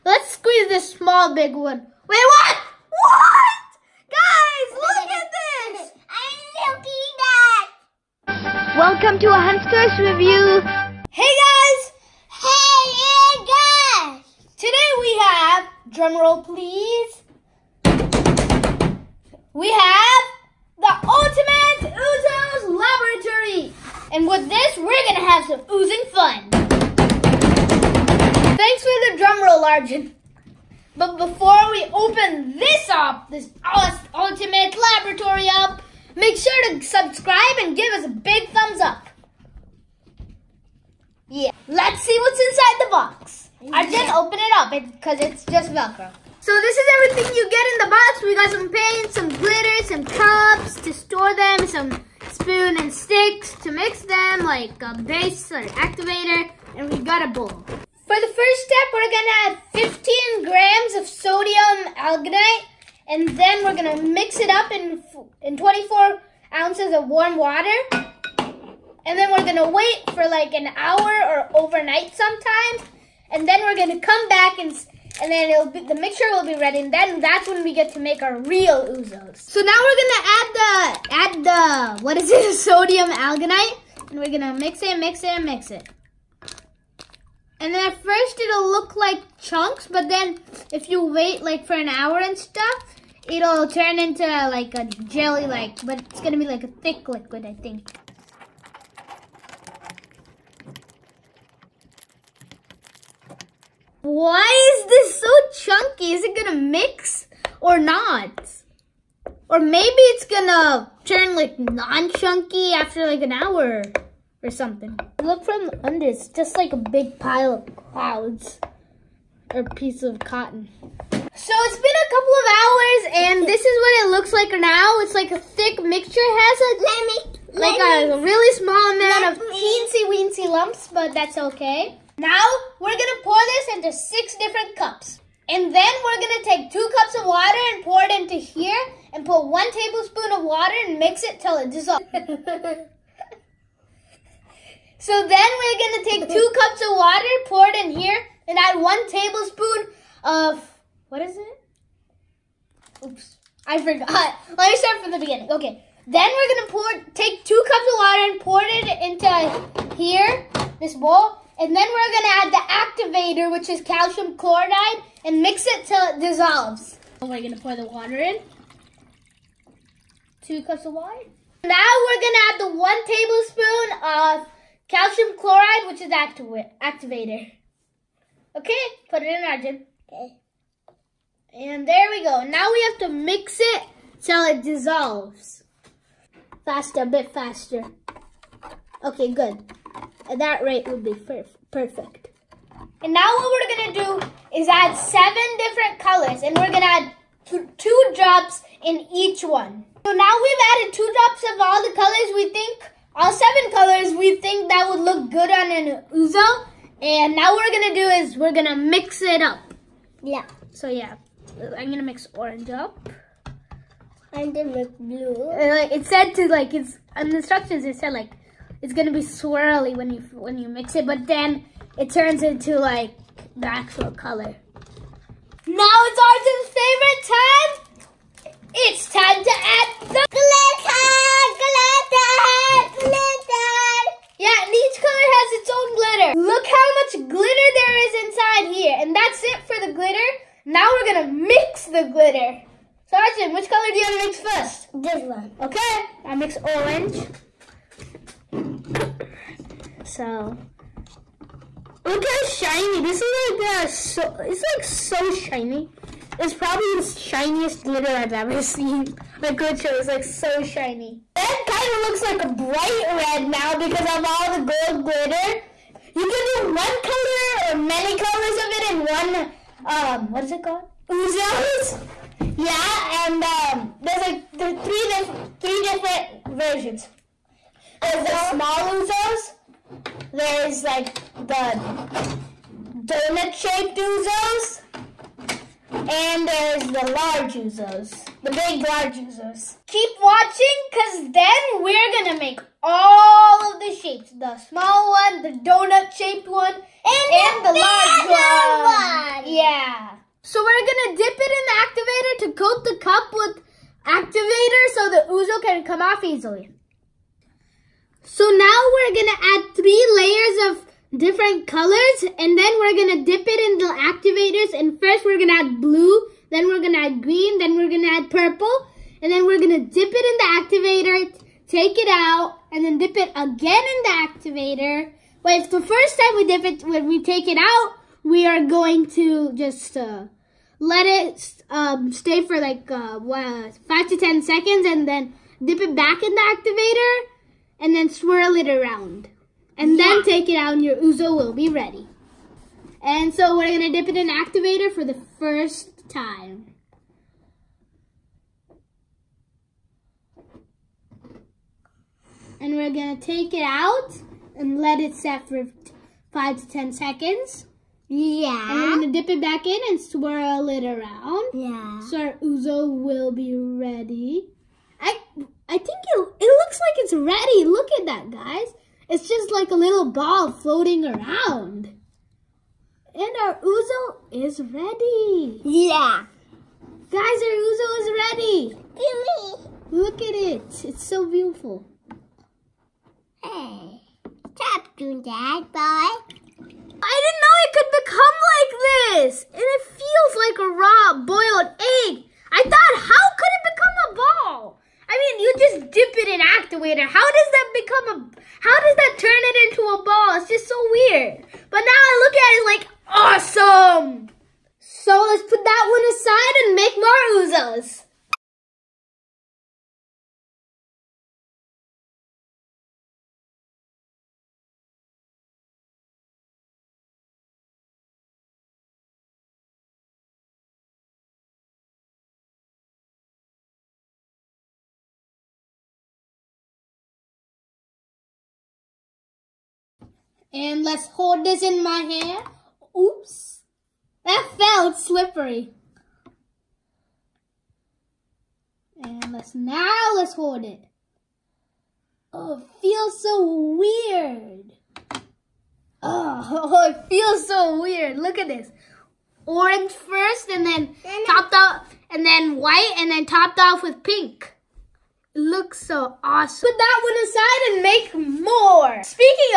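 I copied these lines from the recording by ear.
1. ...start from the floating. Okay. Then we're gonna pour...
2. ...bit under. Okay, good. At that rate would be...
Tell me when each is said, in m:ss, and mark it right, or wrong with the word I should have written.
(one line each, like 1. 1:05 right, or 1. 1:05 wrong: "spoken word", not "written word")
1. 2:34 wrong: "beginning", not "floating"
2. 3:07 wrong: "faster", not "under".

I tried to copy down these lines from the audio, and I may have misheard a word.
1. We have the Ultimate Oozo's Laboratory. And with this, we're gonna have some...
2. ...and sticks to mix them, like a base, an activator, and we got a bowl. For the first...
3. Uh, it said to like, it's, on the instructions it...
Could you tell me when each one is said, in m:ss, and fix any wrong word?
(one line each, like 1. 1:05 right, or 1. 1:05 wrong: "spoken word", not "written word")
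1. 0:19 right
2. 0:52 right
3. 3:35 right.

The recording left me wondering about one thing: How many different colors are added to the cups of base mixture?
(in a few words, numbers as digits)
7.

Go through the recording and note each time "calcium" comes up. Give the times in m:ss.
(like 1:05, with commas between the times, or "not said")
2:43, 2:54.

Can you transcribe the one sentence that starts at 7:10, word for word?
And let's hold this in my hand.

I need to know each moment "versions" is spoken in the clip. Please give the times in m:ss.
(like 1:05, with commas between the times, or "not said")
4:36.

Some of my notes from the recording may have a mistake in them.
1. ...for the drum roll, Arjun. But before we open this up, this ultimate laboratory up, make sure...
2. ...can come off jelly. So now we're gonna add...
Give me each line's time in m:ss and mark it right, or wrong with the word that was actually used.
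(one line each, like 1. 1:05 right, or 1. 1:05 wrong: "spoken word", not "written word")
1. 0:28 right
2. 5:05 wrong: "easily", not "jelly".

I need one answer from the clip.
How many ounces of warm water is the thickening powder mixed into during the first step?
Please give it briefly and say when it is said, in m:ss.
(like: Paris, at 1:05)
24 ounces, at 1:05.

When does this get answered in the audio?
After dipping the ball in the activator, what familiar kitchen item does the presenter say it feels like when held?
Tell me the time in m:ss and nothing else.
6:30.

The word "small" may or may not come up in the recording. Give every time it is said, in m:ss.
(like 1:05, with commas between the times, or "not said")
0:00, 2:08, 4:38, 4:54.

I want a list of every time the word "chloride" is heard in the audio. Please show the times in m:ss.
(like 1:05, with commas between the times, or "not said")
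2:44, 2:55.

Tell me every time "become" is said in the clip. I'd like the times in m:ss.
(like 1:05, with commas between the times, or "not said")
6:28, 6:33, 6:37.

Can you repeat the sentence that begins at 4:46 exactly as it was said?
And there is the large Oozos.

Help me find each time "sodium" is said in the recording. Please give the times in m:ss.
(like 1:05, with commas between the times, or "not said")
1:01, 1:22.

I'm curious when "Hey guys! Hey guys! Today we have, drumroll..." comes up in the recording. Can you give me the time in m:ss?
0:11.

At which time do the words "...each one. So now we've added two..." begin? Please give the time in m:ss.
3:19.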